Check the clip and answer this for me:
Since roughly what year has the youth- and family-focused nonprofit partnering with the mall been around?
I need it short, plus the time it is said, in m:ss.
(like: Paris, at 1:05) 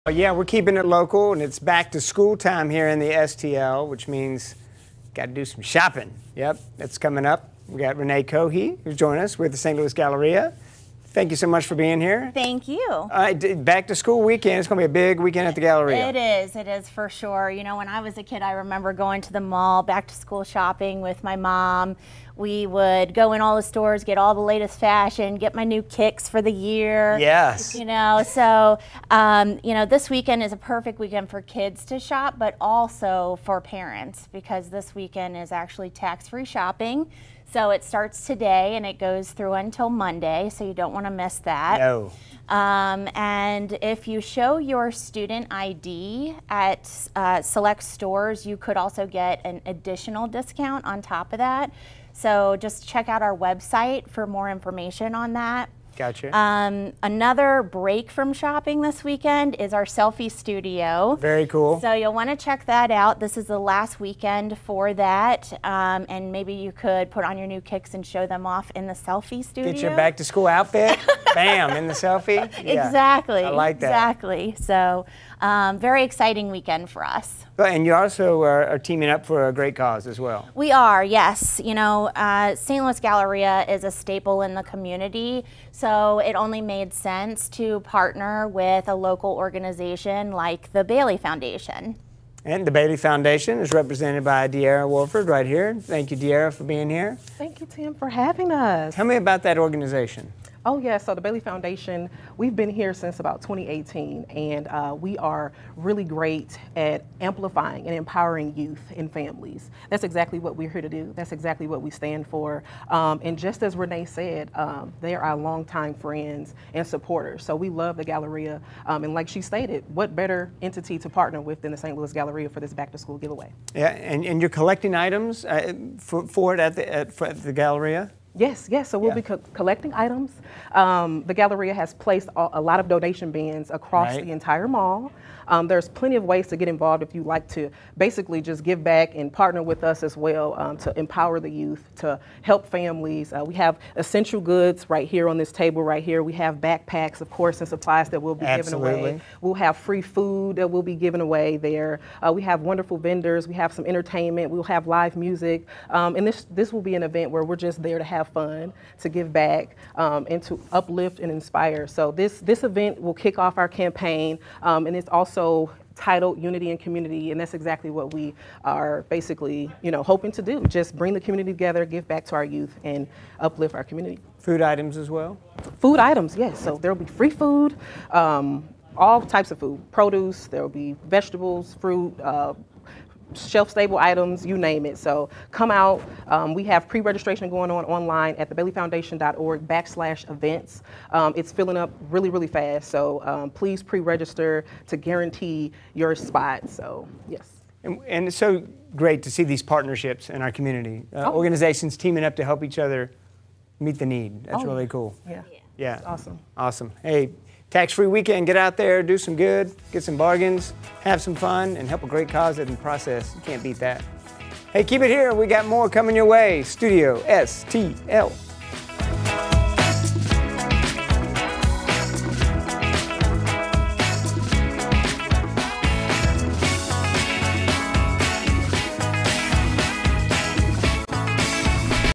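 2018, at 1:43.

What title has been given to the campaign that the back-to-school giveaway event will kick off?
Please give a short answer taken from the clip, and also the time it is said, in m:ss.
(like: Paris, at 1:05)
Unity and Community, at 2:46.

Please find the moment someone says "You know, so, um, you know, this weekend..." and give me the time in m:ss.
0:27.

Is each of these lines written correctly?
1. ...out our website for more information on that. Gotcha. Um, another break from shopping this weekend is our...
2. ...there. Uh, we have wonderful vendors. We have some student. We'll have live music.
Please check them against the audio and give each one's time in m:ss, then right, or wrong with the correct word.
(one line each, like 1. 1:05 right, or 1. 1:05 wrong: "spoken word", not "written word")
1. 0:53 right
2. 2:31 wrong: "entertainment", not "student".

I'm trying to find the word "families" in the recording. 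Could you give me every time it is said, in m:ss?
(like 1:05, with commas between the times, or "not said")
1:49, 2:22.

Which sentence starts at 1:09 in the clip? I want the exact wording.
Get your back to school outfit.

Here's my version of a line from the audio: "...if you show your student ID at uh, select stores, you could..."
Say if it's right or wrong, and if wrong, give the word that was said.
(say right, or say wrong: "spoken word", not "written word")
right.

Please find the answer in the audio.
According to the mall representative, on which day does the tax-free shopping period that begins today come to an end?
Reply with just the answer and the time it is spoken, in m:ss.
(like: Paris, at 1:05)
Monday, at 0:39.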